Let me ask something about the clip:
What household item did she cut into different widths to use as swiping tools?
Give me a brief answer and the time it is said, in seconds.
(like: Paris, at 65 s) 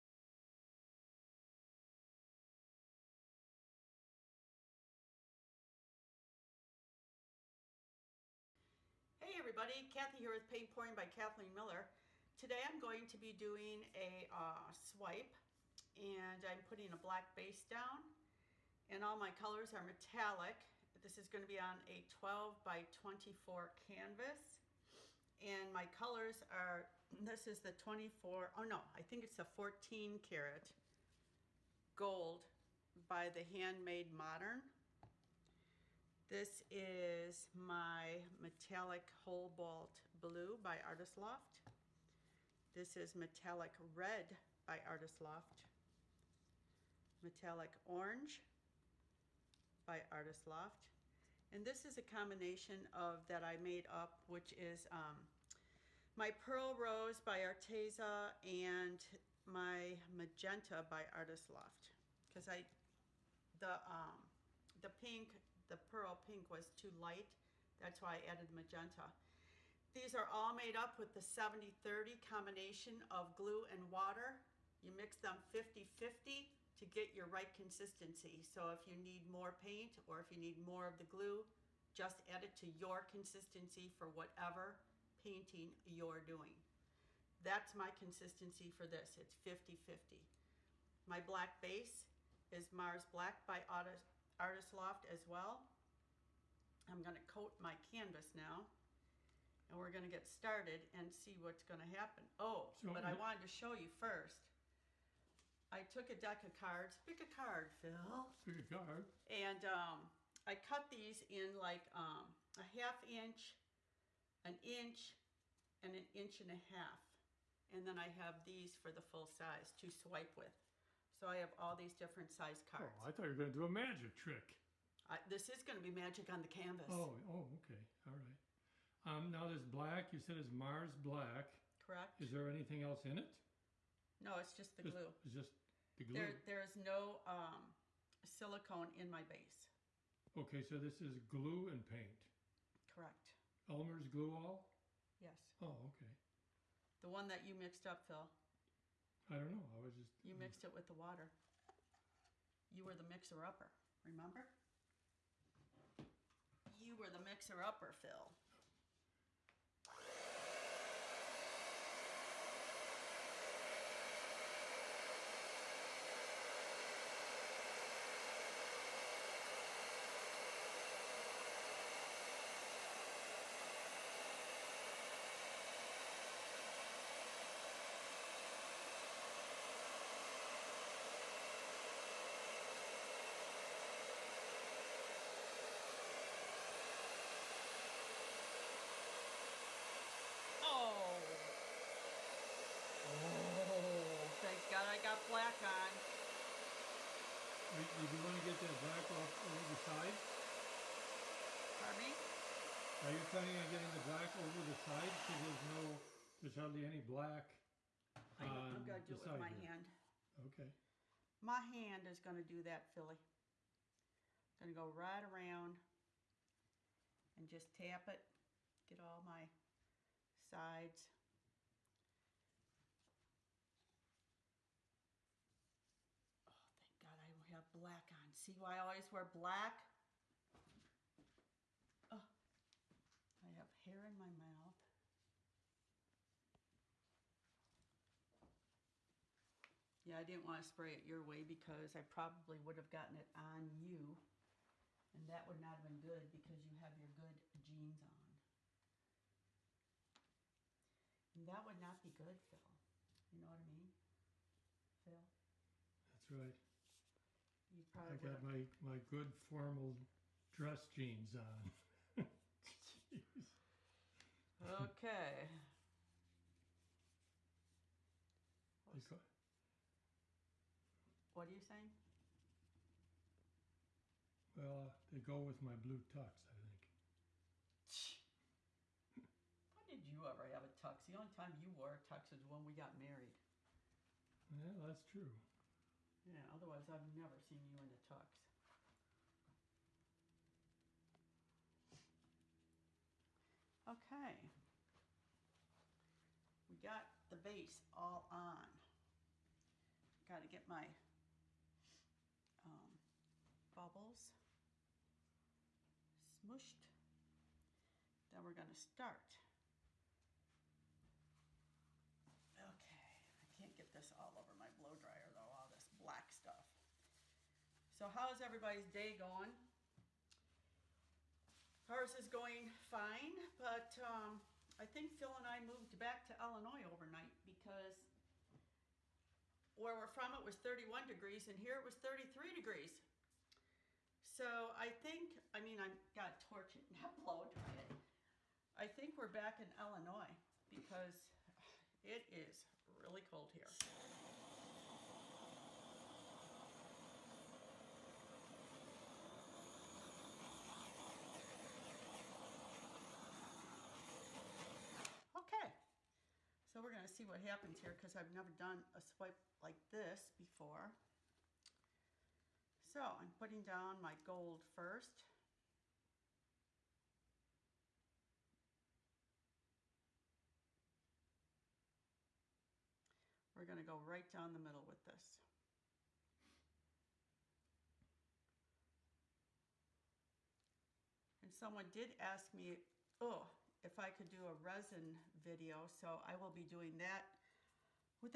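a deck of cards, at 106 s.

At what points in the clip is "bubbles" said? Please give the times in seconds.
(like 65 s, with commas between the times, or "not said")
303 s.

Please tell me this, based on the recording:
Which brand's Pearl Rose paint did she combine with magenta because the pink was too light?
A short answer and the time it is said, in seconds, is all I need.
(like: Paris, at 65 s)
Arteza, at 57 s.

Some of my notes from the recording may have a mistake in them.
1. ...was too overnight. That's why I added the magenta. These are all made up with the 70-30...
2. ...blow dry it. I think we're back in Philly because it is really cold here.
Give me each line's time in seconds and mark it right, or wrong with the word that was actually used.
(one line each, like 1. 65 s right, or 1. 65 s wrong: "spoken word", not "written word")
1. 66 s wrong: "light", not "overnight"
2. 337 s wrong: "Illinois", not "Philly".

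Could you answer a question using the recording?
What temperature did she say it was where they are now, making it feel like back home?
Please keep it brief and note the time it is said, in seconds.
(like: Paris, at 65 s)
33 degrees, at 331 s.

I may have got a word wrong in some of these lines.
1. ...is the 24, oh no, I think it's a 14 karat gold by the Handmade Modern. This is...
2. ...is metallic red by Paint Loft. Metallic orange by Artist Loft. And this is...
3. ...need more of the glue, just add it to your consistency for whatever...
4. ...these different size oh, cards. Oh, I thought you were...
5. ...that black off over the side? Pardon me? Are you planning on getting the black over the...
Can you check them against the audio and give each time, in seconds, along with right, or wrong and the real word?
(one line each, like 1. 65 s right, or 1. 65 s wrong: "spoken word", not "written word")
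1. 27 s right
2. 42 s wrong: "Artist", not "Paint"
3. 80 s right
4. 121 s right
5. 198 s right.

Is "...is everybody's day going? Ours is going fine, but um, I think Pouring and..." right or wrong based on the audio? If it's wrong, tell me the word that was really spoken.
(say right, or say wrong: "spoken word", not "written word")
wrong: "Phil", not "Pouring".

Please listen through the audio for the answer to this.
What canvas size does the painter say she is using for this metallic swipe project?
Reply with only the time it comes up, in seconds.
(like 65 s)
22 s.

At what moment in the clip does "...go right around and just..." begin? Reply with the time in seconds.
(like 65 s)
214 s.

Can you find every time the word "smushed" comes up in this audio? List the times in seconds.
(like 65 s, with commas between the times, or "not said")
306 s.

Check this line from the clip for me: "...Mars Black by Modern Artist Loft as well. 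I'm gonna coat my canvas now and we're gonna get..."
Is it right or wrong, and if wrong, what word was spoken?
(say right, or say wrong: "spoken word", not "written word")
wrong: "Auto", not "Modern".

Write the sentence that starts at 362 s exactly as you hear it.
So I'm putting down my gold first.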